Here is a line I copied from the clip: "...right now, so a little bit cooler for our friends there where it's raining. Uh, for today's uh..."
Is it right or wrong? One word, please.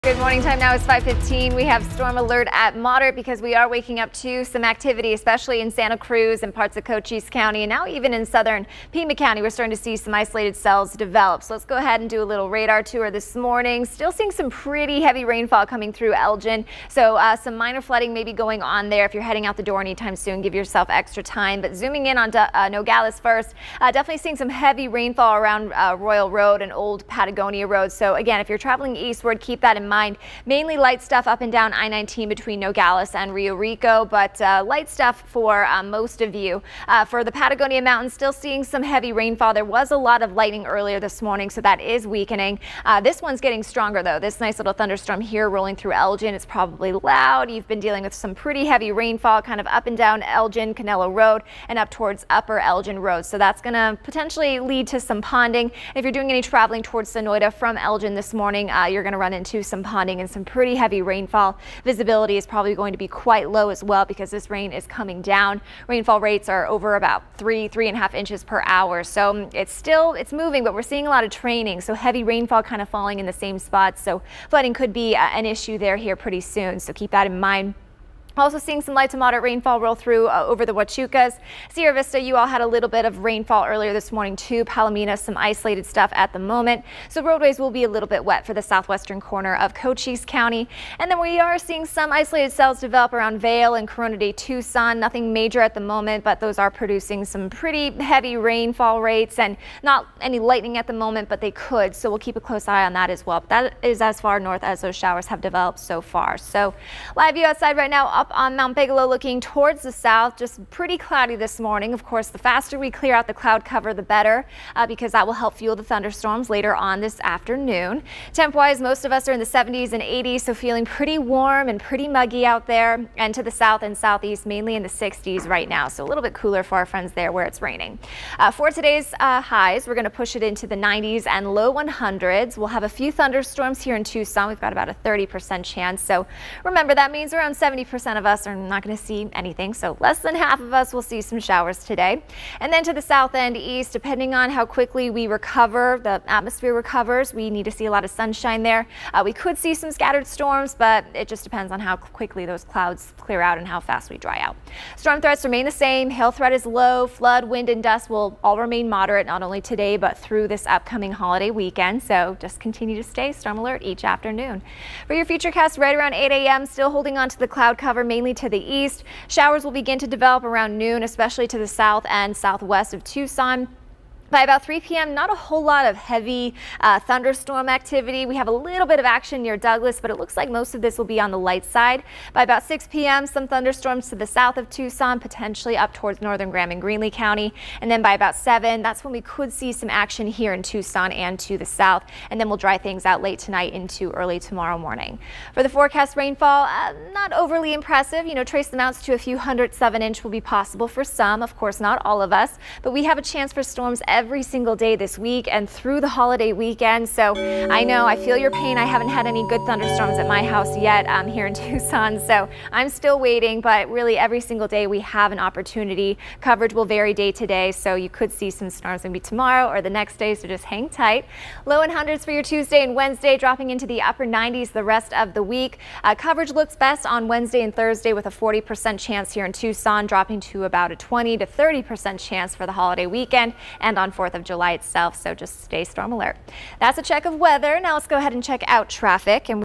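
right.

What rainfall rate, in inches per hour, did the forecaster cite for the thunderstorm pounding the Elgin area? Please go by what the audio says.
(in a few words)
3 to 3.5 inches per hour.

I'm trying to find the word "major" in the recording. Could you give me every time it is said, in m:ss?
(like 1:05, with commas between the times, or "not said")
1:35.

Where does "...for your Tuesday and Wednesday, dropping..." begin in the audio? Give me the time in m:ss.
3:42.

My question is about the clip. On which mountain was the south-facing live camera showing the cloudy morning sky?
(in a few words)
Mount Bigelow.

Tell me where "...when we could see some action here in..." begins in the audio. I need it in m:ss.
3:09.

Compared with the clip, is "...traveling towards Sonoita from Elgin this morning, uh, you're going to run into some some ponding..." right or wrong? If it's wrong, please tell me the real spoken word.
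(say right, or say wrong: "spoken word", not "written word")
right.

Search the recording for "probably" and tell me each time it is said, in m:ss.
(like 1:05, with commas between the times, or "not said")
0:46, 1:02.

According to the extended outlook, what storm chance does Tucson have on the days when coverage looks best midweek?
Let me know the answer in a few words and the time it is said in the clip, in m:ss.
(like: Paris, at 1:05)
40%, at 3:48.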